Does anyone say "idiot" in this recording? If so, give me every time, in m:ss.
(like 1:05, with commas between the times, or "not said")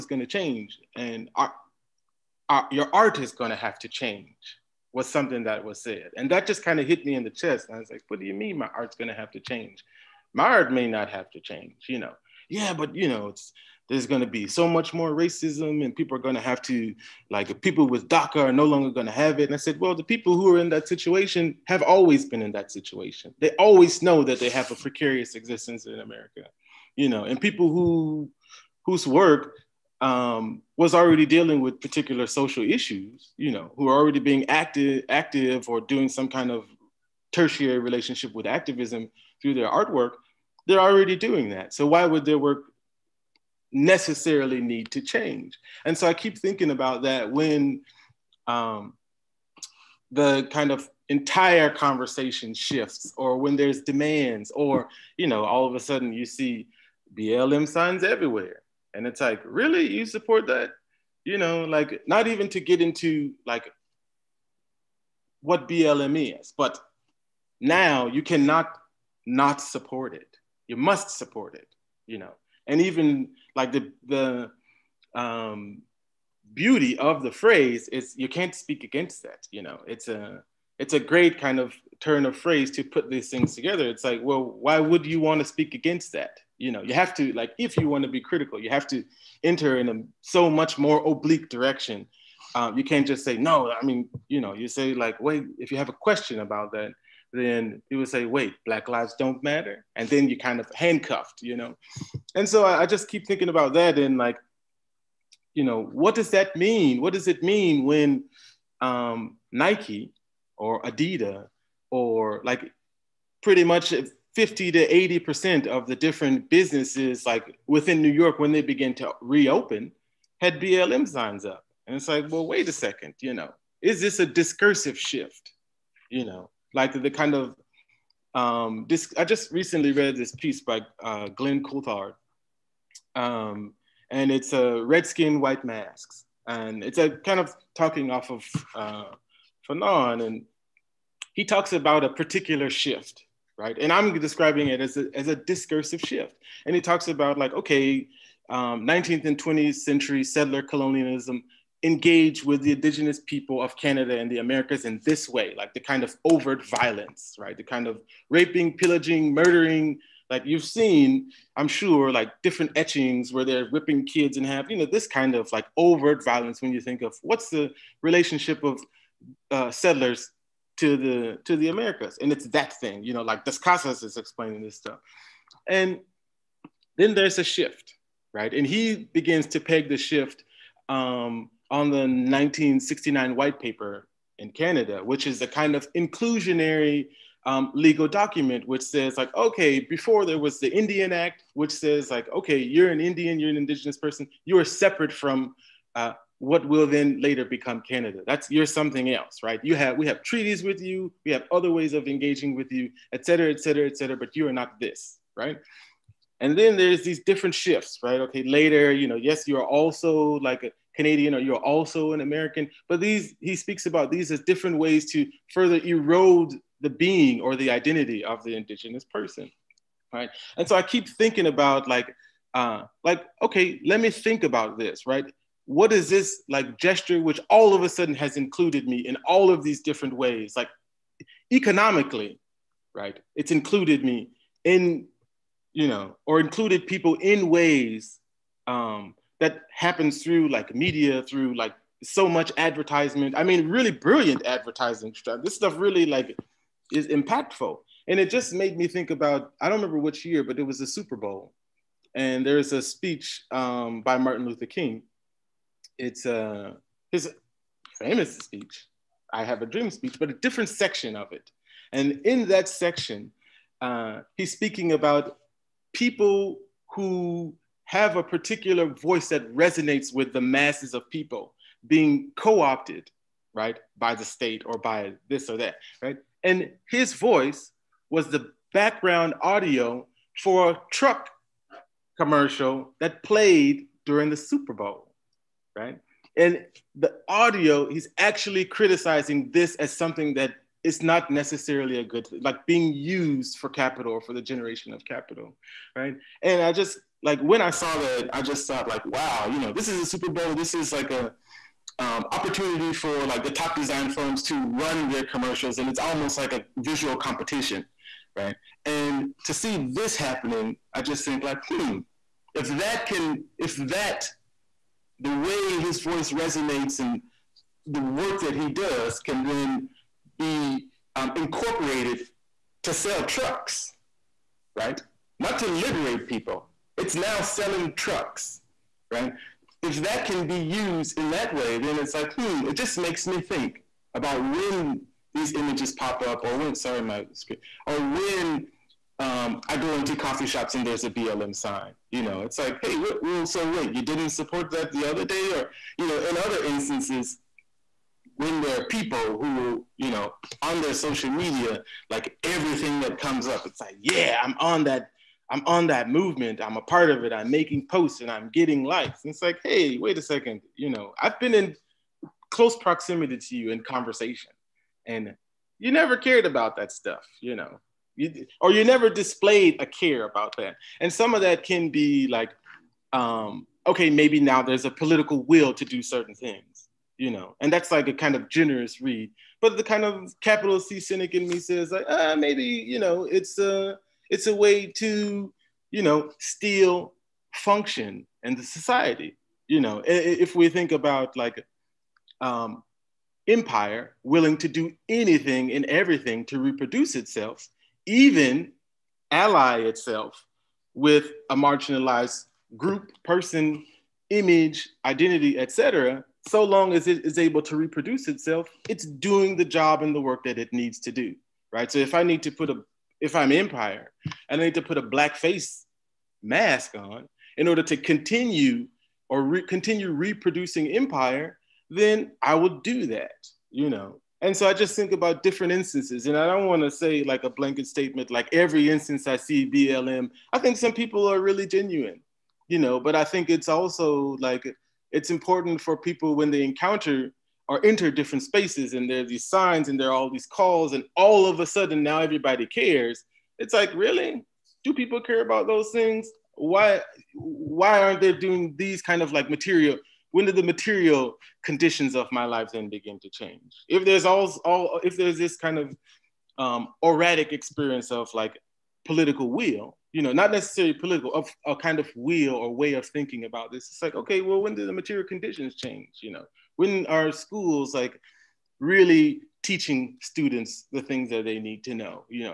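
not said.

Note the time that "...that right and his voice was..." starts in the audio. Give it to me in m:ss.
4:35.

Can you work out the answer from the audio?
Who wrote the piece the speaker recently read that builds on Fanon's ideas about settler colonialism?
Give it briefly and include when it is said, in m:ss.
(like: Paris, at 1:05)
Glenn Coulthard, at 2:11.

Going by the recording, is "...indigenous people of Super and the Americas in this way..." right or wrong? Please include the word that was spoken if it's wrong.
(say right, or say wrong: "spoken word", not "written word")
wrong: "Canada", not "Super".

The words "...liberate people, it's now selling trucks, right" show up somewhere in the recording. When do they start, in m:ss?
5:25.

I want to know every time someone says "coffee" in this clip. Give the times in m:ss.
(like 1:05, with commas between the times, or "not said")
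5:40.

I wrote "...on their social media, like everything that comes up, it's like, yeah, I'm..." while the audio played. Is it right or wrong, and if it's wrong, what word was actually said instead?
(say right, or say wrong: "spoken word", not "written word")
right.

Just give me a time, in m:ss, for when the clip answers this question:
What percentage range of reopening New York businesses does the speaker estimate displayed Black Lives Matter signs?
1:54.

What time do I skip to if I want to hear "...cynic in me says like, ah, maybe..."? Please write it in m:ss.
6:20.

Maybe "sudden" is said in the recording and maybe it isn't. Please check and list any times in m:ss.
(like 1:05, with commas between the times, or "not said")
0:55, 3:47, 7:21.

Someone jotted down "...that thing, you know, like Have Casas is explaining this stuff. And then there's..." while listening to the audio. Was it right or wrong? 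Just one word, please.
wrong.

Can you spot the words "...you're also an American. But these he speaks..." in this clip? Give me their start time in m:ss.
3:31.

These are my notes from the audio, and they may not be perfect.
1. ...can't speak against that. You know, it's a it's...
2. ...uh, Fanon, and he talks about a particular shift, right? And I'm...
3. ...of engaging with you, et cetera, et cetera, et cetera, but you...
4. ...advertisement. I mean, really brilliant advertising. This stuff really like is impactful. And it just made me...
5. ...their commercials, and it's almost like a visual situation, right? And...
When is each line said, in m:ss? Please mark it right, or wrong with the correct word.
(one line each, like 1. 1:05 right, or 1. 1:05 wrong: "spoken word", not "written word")
1. 1:18 right
2. 2:18 right
3. 3:21 right
4. 4:02 right
5. 5:05 wrong: "competition", not "situation".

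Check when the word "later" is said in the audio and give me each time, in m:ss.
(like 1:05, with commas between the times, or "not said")
3:17, 3:28.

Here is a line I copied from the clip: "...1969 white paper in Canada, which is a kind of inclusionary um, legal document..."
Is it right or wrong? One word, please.
right.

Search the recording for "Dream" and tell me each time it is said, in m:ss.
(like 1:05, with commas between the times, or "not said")
4:19.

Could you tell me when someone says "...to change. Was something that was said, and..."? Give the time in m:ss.
0:03.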